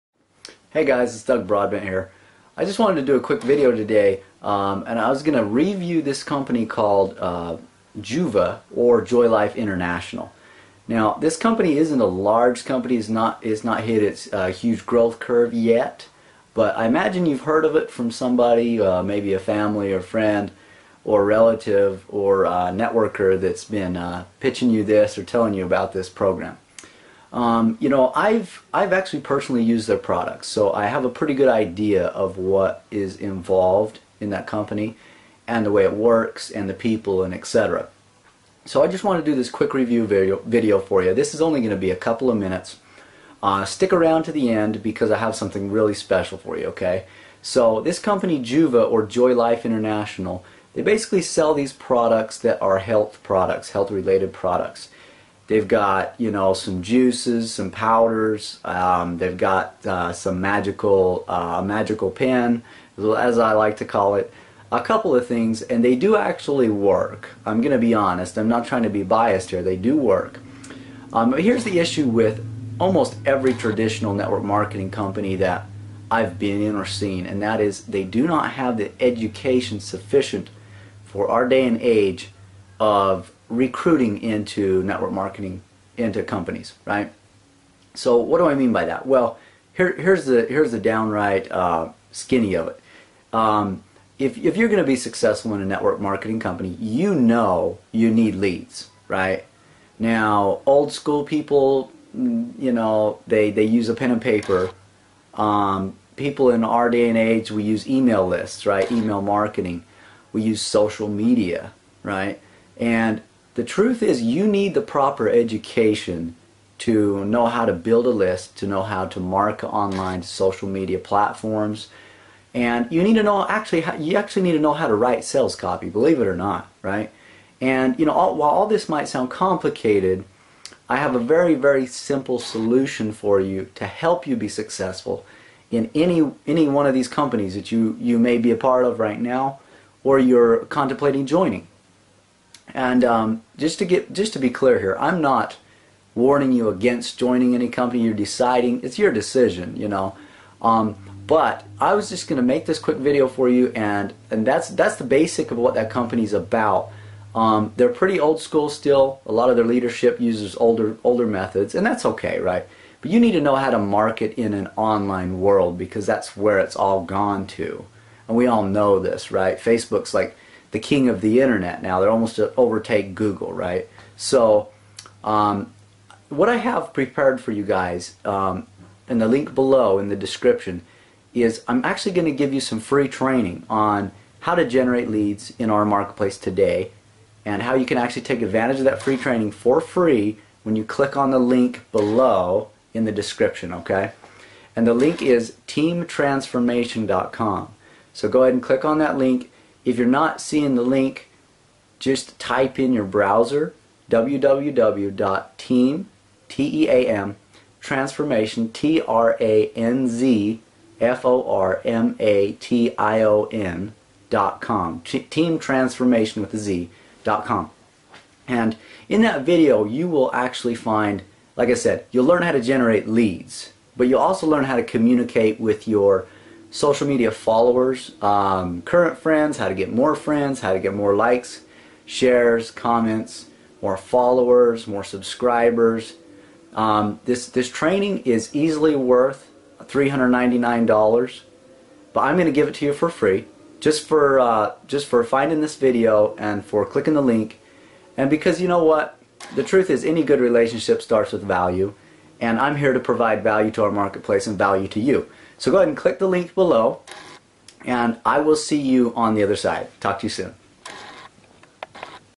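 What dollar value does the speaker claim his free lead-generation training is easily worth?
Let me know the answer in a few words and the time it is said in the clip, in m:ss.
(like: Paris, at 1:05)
$399, at 3:59.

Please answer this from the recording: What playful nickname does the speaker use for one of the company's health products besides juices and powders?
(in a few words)
magical pen.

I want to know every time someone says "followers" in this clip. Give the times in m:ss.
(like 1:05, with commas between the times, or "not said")
3:47, 3:53.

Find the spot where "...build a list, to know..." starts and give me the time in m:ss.
1:57.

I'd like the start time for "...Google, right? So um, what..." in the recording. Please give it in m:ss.
2:53.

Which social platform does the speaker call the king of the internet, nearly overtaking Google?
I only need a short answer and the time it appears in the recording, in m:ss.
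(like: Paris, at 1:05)
Facebook, at 2:49.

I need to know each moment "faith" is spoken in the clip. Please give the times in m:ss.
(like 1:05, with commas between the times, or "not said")
not said.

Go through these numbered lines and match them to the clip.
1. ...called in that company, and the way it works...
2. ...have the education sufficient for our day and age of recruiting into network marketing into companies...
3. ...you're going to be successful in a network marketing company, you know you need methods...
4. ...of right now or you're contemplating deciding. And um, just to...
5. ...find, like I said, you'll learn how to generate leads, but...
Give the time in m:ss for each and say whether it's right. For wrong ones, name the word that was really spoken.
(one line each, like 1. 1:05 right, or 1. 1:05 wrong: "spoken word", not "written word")
1. 0:33 wrong: "involved", not "called"
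2. 1:18 right
3. 1:34 wrong: "leads", not "methods"
4. 2:18 wrong: "joining", not "deciding"
5. 3:40 right.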